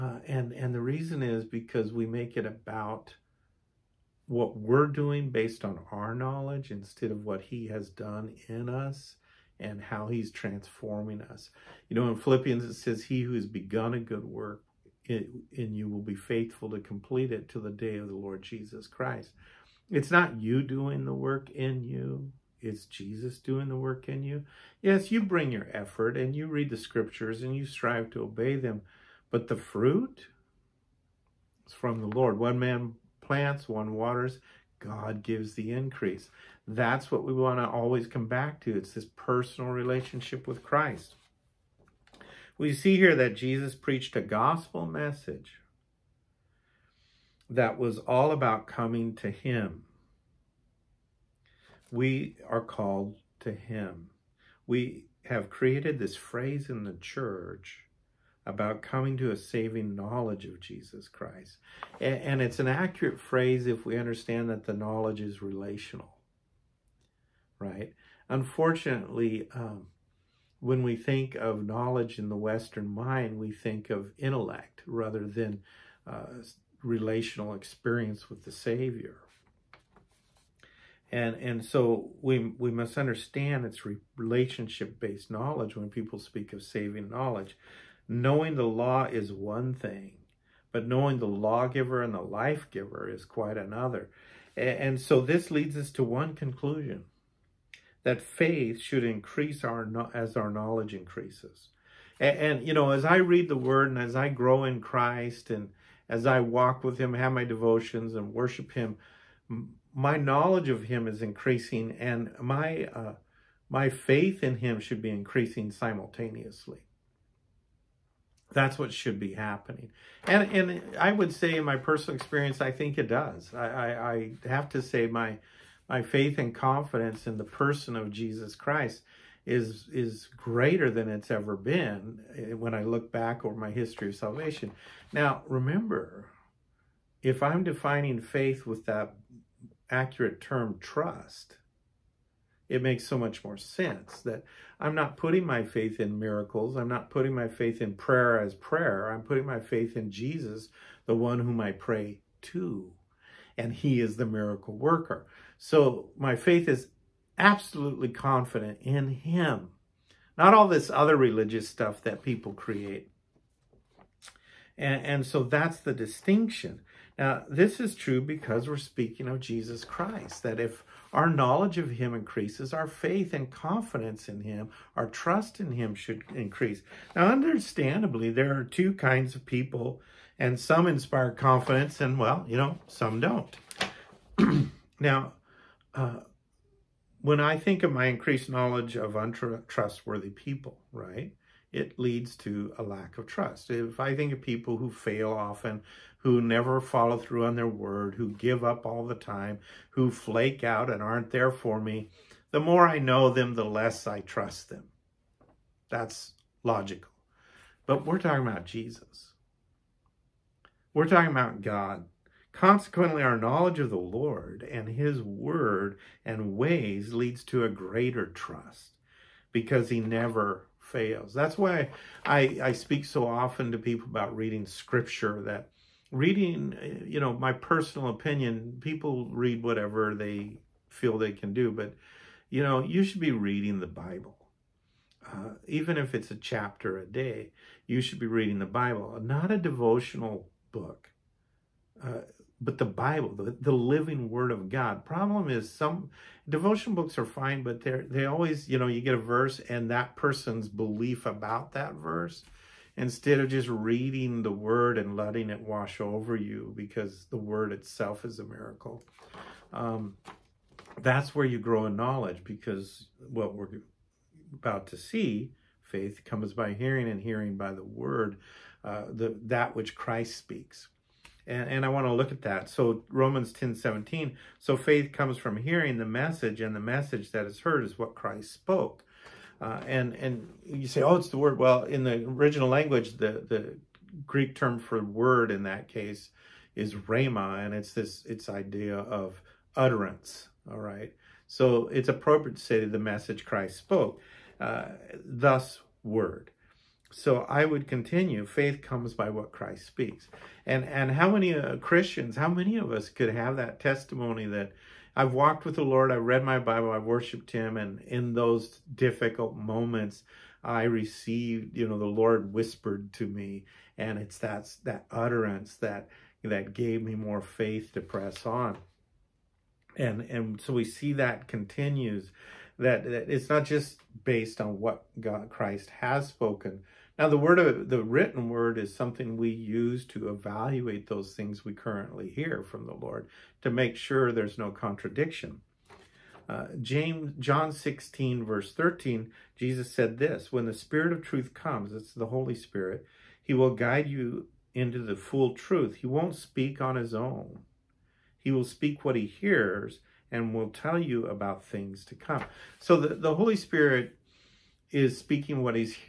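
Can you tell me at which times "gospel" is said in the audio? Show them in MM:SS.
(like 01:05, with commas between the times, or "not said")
00:44.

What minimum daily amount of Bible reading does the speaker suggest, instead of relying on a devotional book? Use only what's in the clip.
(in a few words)
a chapter a day.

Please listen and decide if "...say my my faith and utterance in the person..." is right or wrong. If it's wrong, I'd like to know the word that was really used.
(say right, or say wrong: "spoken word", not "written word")
wrong: "confidence", not "utterance".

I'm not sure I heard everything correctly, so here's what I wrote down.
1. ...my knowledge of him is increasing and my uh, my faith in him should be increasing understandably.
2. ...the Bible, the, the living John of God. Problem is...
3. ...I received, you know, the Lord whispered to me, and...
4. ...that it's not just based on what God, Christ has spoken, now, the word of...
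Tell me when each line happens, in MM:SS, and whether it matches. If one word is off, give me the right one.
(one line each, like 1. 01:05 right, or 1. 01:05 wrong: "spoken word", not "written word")
1. 01:49 wrong: "simultaneously", not "understandably"
2. 04:02 wrong: "Word", not "John"
3. 05:10 right
4. 05:23 right.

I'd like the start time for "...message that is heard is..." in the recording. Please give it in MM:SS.
04:36.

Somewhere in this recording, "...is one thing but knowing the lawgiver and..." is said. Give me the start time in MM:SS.
01:29.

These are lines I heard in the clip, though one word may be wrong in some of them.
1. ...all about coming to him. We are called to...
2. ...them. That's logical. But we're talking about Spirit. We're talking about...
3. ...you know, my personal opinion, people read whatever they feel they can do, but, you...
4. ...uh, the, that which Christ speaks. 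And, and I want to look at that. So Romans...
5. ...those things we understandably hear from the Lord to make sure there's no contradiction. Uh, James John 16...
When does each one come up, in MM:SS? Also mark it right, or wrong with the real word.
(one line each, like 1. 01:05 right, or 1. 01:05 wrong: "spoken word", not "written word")
1. 00:47 right
2. 03:24 wrong: "Jesus", not "Spirit"
3. 03:47 right
4. 04:28 right
5. 05:31 wrong: "currently", not "understandably".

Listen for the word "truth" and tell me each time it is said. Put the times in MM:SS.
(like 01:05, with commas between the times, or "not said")
05:41, 05:45.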